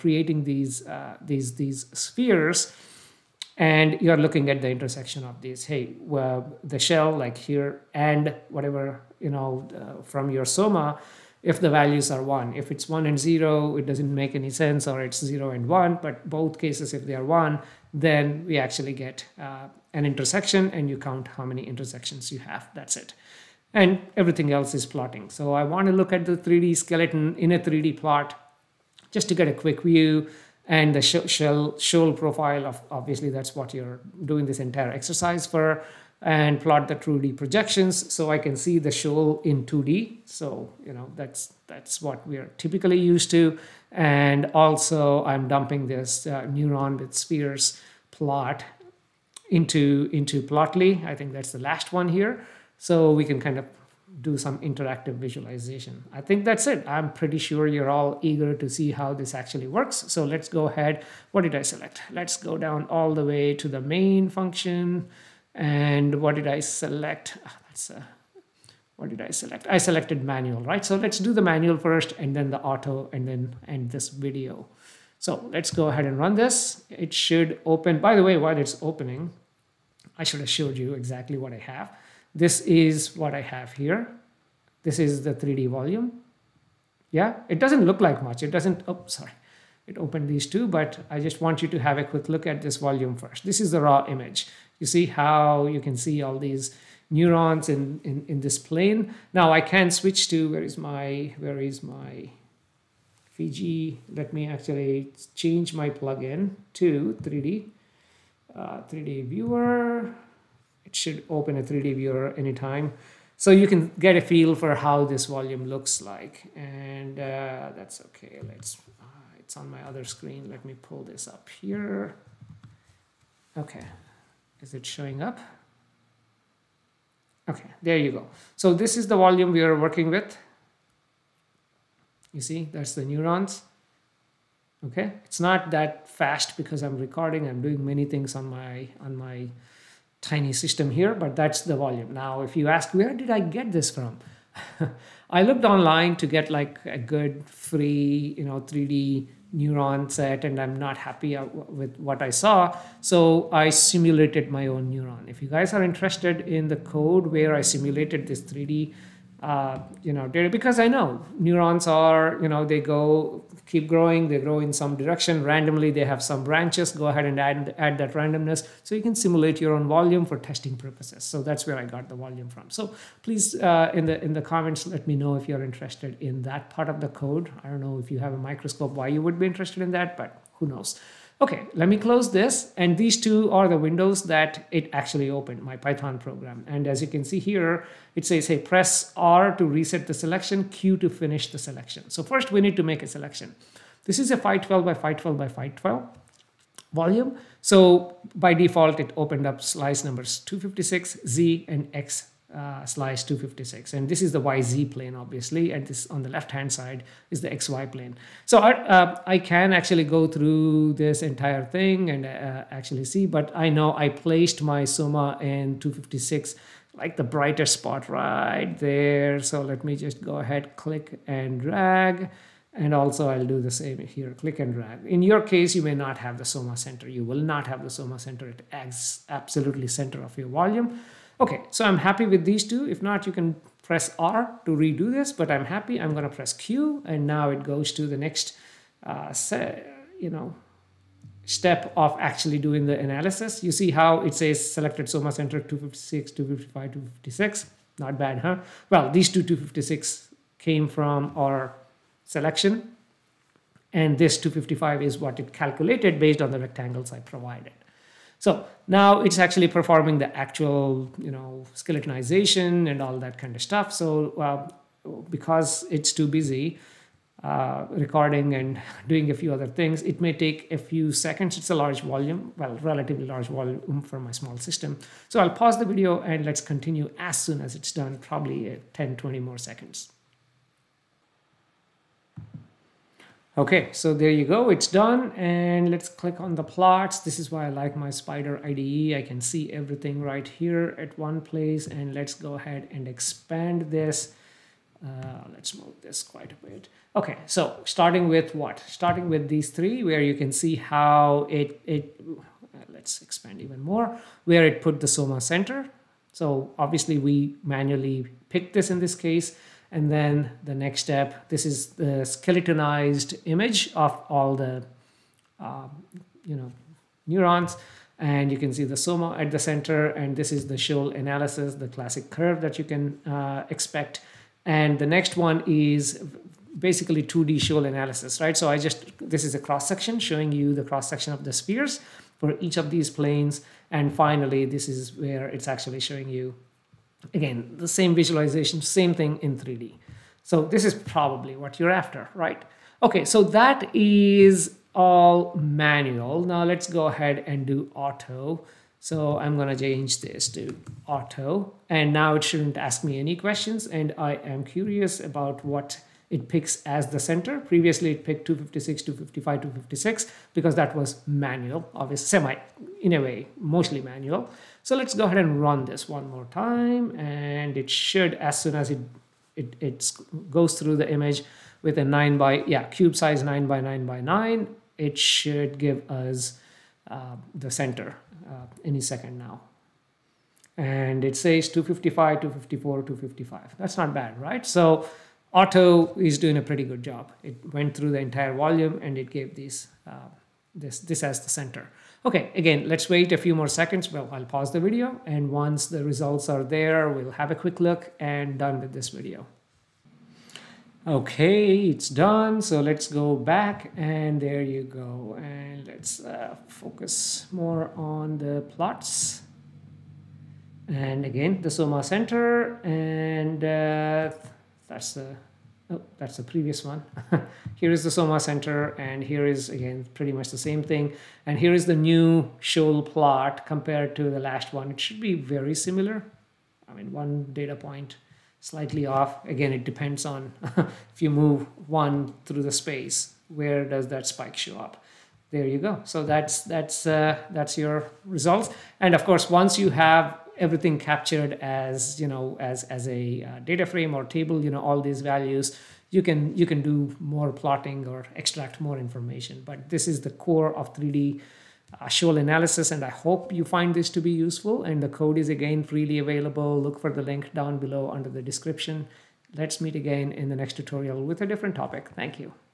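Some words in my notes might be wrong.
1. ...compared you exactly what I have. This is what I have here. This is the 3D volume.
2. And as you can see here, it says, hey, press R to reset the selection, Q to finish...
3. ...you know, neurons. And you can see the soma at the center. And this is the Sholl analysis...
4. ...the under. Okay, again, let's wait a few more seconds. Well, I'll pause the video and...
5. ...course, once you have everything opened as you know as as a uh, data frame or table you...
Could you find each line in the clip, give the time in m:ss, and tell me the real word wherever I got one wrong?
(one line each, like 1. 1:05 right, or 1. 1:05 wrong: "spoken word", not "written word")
1. 1:20 wrong: "showed", not "compared"
2. 3:06 right
3. 5:16 right
4. 6:31 wrong: "center", not "under"
5. 7:19 wrong: "captured", not "opened".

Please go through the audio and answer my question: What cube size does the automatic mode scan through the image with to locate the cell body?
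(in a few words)
9 by 9 by 9.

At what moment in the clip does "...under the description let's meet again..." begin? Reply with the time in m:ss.
7:38.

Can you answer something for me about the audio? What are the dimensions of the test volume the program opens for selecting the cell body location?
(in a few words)
512 by 512 by 512.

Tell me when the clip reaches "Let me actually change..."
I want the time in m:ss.
1:44.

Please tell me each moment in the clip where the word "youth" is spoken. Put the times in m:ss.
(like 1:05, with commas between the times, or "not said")
not said.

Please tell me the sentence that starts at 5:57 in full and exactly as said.
Previously it picked 256, 255, 256 because that was manual, obviously semi in a way, mostly manual.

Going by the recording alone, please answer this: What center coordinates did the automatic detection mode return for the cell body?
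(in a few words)
255, 254, 255.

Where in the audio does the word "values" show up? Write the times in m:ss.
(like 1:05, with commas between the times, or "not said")
0:11, 7:25.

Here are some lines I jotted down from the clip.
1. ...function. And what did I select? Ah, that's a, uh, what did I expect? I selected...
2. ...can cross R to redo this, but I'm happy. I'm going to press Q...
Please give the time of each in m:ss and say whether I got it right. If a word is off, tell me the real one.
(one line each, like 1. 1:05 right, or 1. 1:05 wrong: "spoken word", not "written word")
1. 1:04 wrong: "select", not "expect"
2. 3:53 wrong: "press", not "cross".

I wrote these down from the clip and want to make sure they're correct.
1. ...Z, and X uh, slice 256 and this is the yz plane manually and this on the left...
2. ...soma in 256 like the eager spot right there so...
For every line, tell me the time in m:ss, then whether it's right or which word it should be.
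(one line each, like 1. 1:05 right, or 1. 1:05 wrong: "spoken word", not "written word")
1. 3:21 wrong: "obviously", not "manually"
2. 3:34 wrong: "brighter", not "eager".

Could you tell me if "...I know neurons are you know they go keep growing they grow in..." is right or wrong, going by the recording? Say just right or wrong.
right.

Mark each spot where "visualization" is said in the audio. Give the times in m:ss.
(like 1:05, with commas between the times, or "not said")
0:55, 5:38.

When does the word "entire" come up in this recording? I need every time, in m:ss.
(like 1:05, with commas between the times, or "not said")
0:34, 3:31, 6:28.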